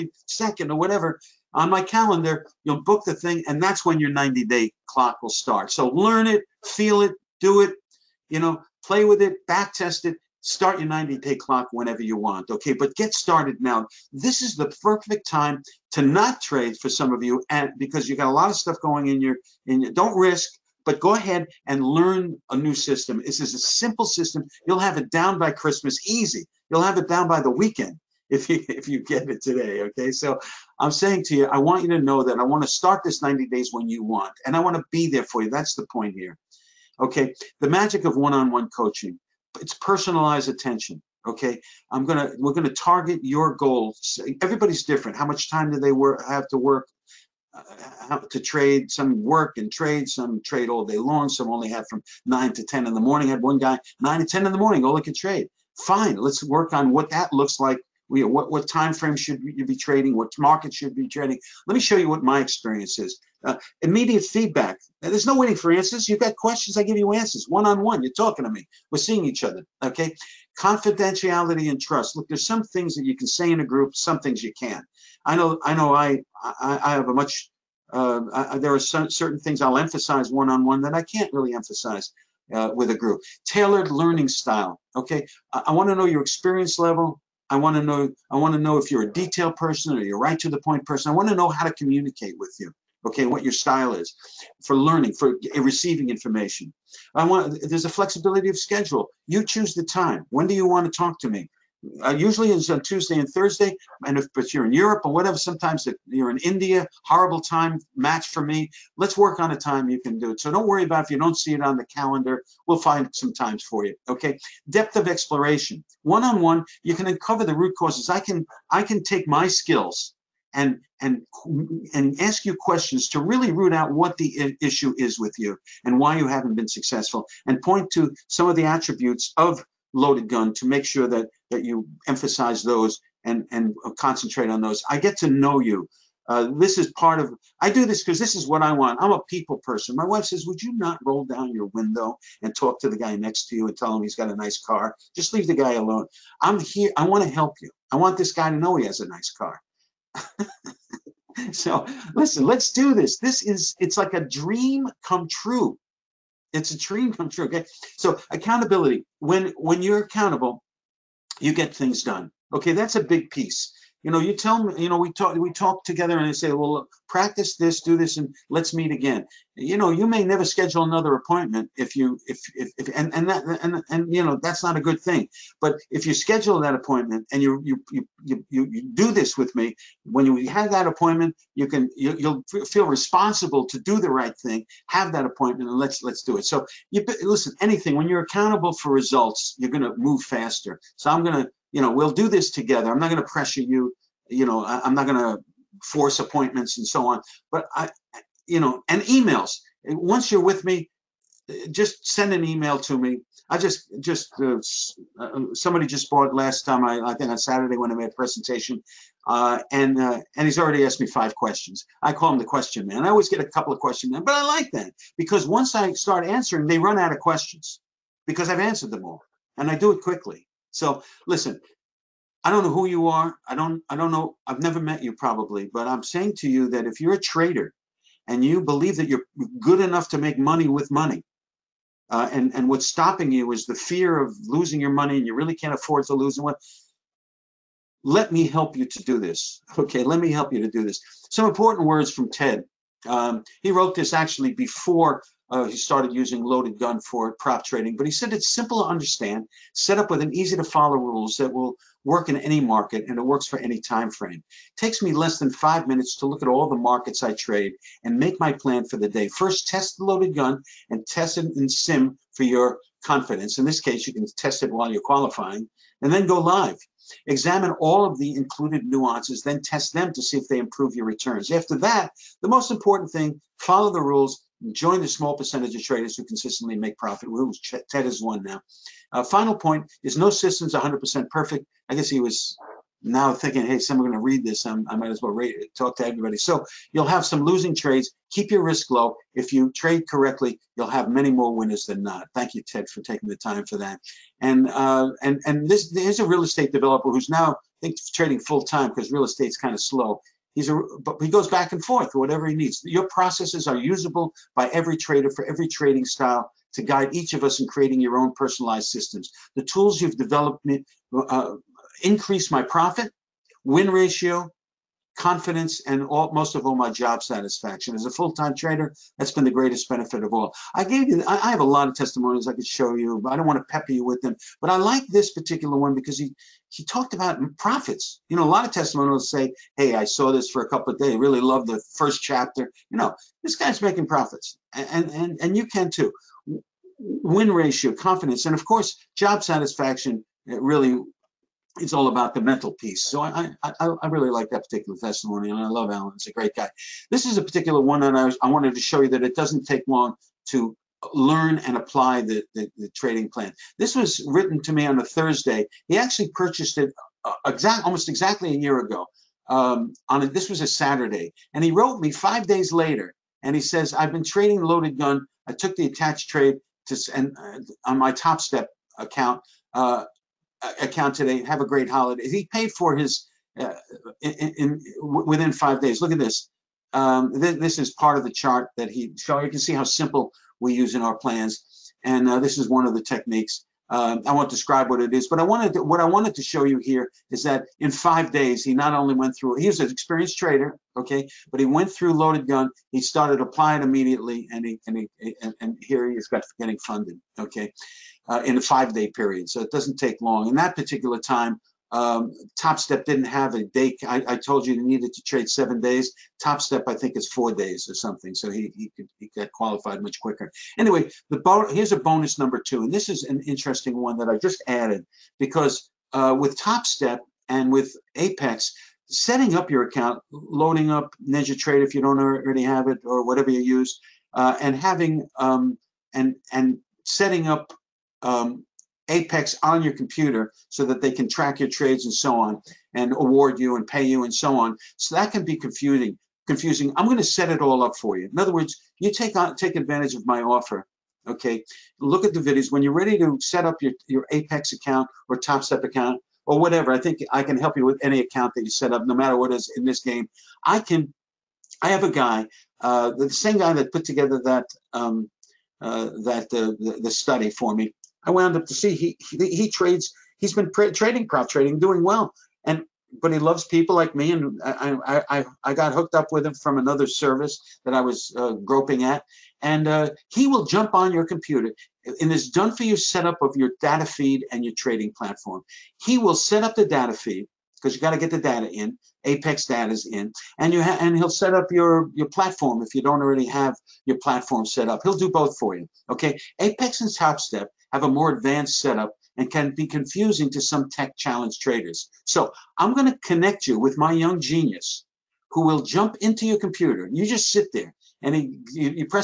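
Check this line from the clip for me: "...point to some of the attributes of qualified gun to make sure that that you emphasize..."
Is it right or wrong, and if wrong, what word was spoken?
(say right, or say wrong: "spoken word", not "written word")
wrong: "loaded", not "qualified".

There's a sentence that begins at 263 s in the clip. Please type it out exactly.
In this case, you can test it while you're qualifying and then go live.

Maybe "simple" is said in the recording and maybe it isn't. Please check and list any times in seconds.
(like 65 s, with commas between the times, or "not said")
23 s, 248 s, 379 s.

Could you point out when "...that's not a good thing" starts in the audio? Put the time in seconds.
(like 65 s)
174 s.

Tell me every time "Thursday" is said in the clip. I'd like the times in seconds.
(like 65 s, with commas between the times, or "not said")
103 s, 355 s.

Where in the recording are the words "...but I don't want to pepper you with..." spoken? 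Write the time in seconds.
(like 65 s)
323 s.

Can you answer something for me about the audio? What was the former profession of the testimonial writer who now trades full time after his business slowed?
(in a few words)
real estate developer.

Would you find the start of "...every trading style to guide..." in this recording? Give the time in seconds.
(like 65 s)
305 s.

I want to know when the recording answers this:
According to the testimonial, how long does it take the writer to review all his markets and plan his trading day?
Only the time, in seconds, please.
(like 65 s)
255 s.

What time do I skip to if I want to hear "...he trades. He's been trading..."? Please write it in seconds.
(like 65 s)
459 s.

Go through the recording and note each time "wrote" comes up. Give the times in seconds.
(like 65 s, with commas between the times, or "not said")
243 s, 361 s.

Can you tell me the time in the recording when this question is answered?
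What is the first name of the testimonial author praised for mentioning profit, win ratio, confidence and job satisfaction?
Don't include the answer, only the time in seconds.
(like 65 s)
345 s.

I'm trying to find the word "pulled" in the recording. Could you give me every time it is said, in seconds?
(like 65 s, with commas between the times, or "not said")
not said.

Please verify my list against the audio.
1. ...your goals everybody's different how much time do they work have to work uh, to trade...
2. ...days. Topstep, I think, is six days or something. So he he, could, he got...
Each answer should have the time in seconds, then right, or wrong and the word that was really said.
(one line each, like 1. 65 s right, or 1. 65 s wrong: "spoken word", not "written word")
1. 43 s right
2. 405 s wrong: "four", not "six".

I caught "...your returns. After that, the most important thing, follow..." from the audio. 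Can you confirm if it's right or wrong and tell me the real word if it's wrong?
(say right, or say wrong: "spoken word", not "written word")
right.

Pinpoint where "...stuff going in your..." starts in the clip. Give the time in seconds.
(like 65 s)
18 s.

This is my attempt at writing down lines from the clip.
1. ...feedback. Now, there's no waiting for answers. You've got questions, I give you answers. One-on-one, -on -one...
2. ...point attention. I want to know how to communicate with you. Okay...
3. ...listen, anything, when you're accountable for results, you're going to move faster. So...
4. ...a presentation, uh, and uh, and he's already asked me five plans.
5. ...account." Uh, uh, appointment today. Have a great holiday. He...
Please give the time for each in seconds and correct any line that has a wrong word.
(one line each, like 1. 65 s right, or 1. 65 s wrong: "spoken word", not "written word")
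1. 64 s right
2. 90 s wrong: "person", not "attention"
3. 187 s right
4. 208 s wrong: "questions", not "plans"
5. 368 s wrong: "account", not "appointment".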